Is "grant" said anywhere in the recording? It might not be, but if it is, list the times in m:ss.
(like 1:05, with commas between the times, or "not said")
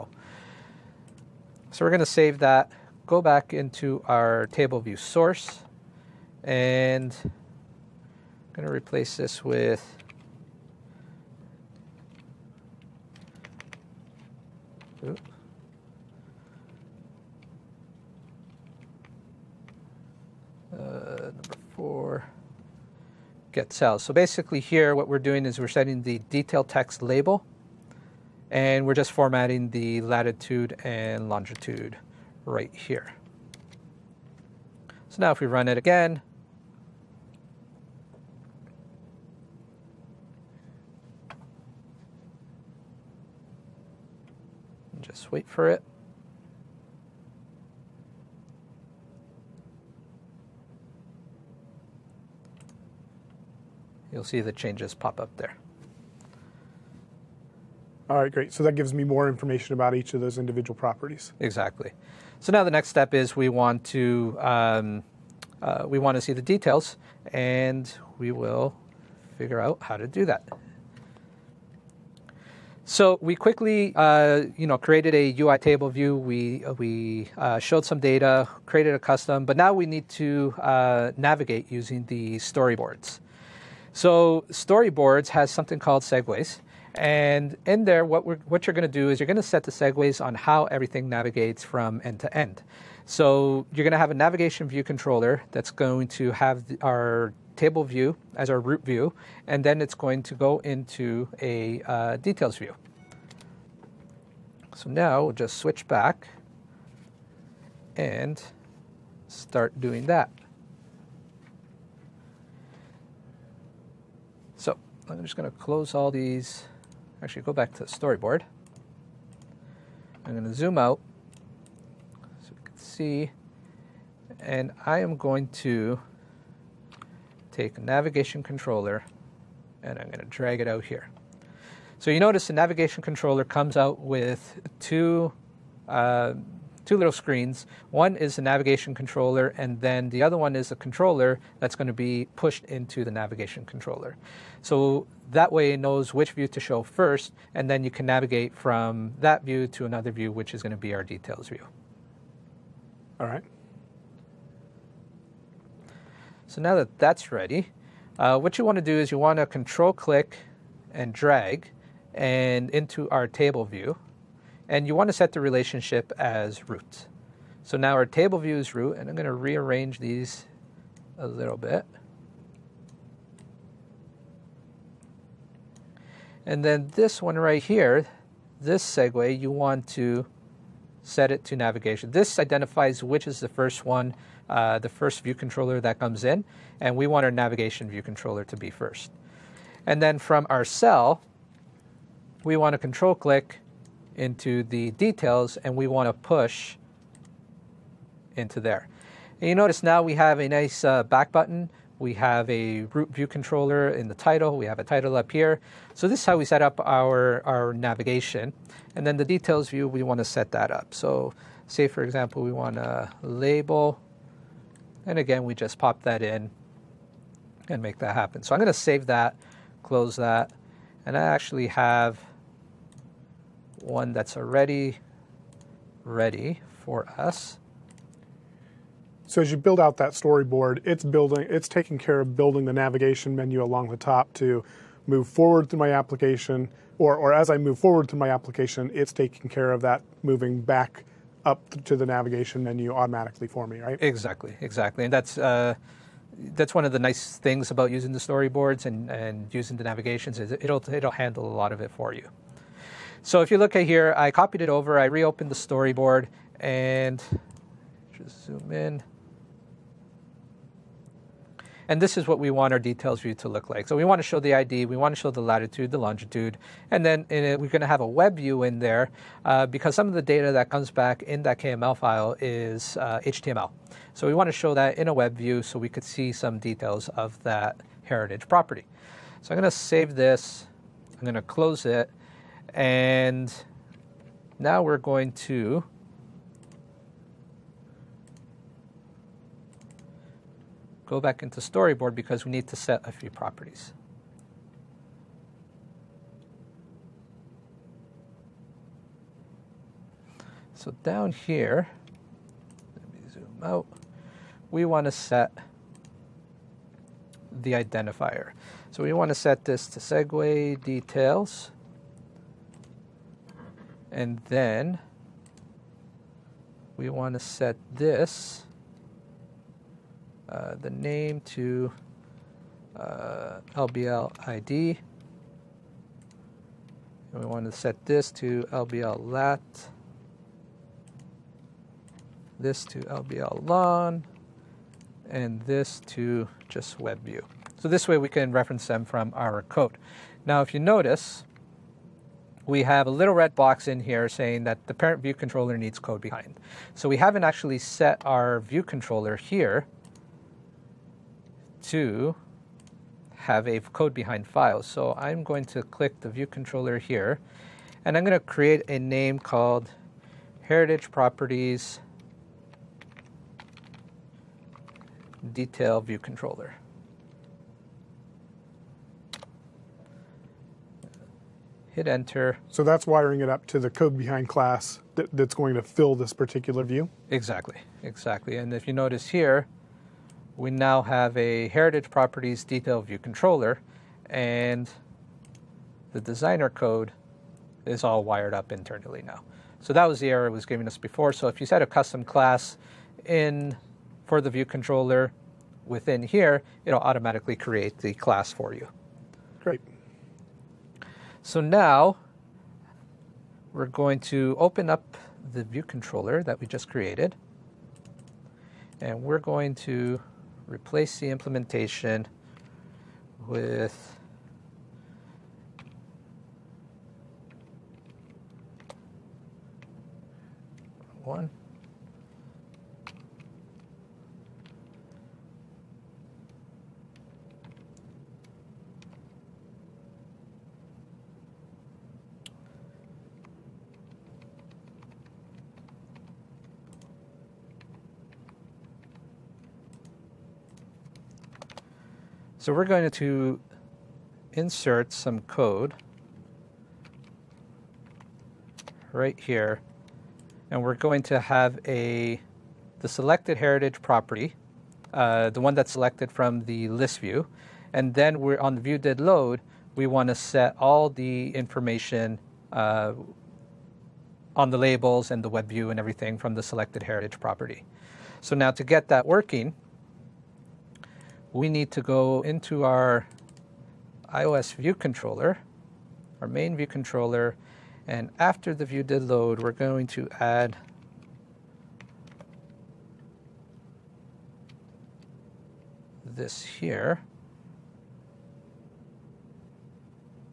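not said.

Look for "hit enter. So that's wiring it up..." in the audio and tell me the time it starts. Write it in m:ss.
6:11.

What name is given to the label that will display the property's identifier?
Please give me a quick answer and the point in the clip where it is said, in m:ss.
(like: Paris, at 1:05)
LBL ID, at 5:23.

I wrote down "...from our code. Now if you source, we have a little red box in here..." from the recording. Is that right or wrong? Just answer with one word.
wrong.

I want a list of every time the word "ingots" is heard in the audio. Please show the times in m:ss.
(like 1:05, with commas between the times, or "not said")
not said.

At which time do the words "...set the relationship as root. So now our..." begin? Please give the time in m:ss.
2:45.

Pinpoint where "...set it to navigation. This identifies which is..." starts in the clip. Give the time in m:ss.
3:01.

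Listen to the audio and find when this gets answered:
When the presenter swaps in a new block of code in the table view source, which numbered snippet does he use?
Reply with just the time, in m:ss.
0:15.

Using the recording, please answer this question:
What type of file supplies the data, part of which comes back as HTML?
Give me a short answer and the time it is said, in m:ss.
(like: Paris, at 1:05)
KML, at 4:31.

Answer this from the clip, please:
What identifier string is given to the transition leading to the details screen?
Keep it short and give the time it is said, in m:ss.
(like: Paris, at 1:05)
segue details, at 5:09.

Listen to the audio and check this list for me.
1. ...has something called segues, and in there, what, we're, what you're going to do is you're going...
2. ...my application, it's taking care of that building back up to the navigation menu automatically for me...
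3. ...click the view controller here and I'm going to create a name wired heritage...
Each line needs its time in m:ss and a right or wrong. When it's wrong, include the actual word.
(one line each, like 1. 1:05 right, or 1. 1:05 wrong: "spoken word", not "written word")
1. 1:25 right
2. 3:58 wrong: "moving", not "building"
3. 5:55 wrong: "called", not "wired".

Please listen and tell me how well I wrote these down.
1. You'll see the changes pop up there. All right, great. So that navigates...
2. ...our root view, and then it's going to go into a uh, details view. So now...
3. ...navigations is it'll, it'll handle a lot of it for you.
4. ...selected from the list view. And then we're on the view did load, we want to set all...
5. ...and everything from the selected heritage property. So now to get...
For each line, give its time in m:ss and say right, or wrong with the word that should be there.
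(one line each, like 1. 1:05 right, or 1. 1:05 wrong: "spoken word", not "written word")
1. 0:54 wrong: "gives", not "navigates"
2. 1:38 right
3. 4:09 right
4. 7:35 right
5. 7:45 right.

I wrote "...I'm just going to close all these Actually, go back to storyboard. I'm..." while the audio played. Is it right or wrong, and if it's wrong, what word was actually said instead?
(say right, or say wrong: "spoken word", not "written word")
right.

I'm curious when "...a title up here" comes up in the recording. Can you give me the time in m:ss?
3:24.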